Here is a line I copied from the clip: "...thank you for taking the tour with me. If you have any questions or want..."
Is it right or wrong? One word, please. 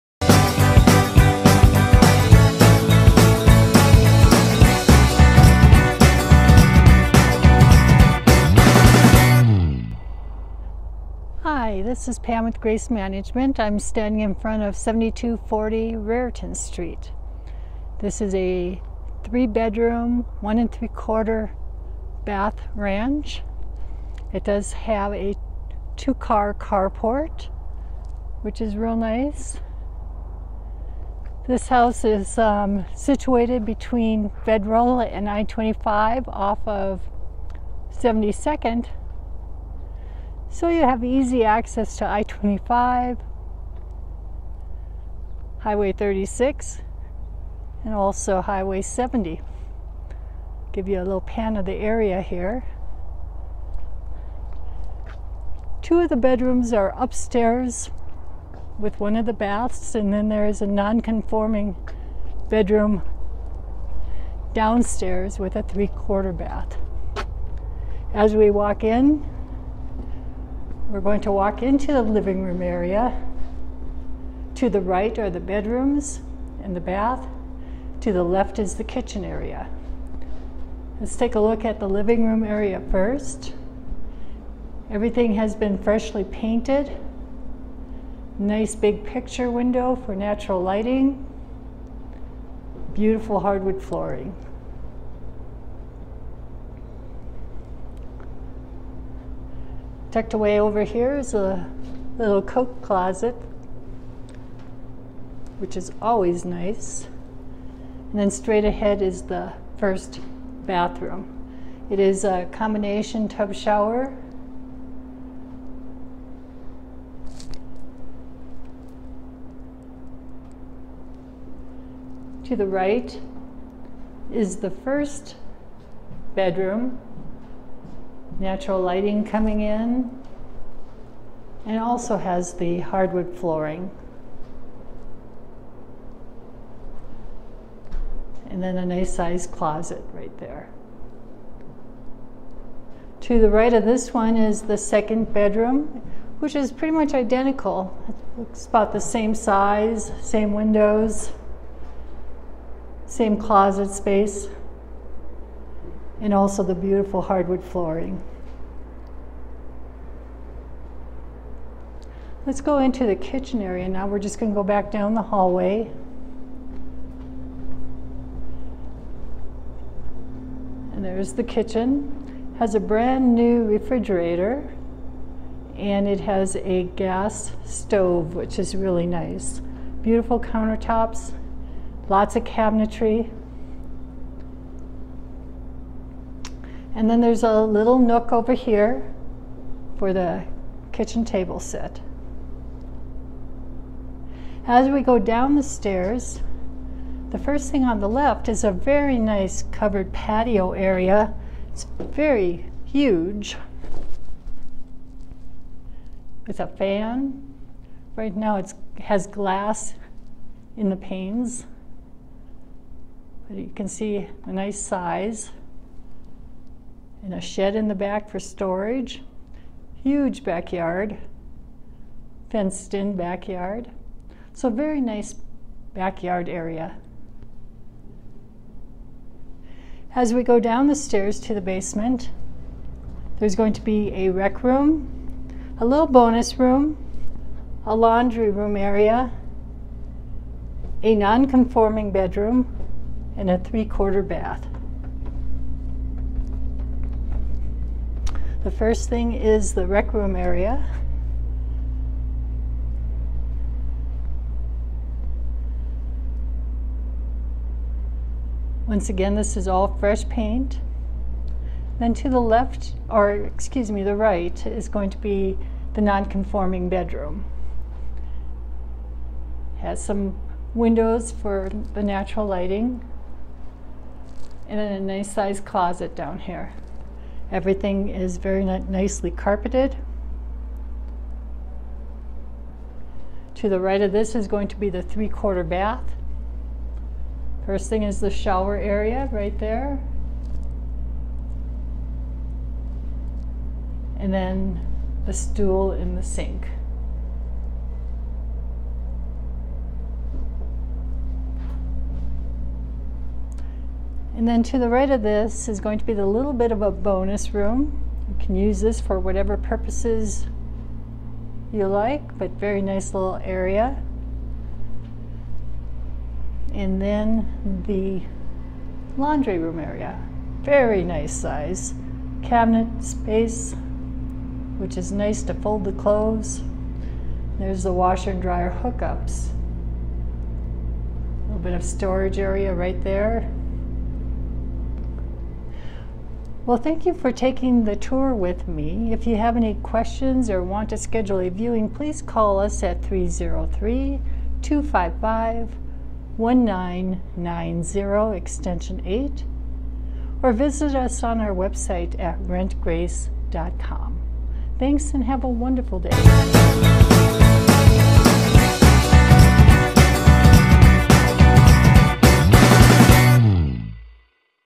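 right.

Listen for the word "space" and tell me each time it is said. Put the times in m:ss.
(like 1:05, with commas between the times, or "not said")
2:33, 5:23.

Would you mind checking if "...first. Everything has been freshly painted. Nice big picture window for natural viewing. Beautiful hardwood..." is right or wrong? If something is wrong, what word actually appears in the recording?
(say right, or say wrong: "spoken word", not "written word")
wrong: "lighting", not "viewing".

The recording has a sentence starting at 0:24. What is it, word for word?
It does have a two car carport, which is real nice.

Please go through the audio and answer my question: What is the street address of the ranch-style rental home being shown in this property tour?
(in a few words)
7240 Raritan Street.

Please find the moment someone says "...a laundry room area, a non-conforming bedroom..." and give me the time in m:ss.
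3:57.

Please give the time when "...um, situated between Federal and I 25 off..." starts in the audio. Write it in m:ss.
0:32.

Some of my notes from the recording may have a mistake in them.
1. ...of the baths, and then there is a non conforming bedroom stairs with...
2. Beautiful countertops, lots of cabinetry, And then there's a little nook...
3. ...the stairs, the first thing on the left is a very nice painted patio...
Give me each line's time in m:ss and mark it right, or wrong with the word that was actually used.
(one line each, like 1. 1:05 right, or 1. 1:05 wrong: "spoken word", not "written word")
1. 0:59 wrong: "downstairs", not "stairs"
2. 3:00 right
3. 3:15 wrong: "covered", not "painted".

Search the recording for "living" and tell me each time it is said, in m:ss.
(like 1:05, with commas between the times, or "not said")
1:12, 1:21.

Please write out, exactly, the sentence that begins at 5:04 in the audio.
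And then to the right of this is going to be the little bit of a bonus room.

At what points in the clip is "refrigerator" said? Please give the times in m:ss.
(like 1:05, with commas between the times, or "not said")
2:53.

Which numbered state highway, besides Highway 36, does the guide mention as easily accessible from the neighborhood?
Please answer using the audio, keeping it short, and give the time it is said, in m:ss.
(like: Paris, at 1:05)
Highway 70, at 0:48.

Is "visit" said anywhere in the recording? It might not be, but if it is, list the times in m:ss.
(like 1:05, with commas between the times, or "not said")
5:50.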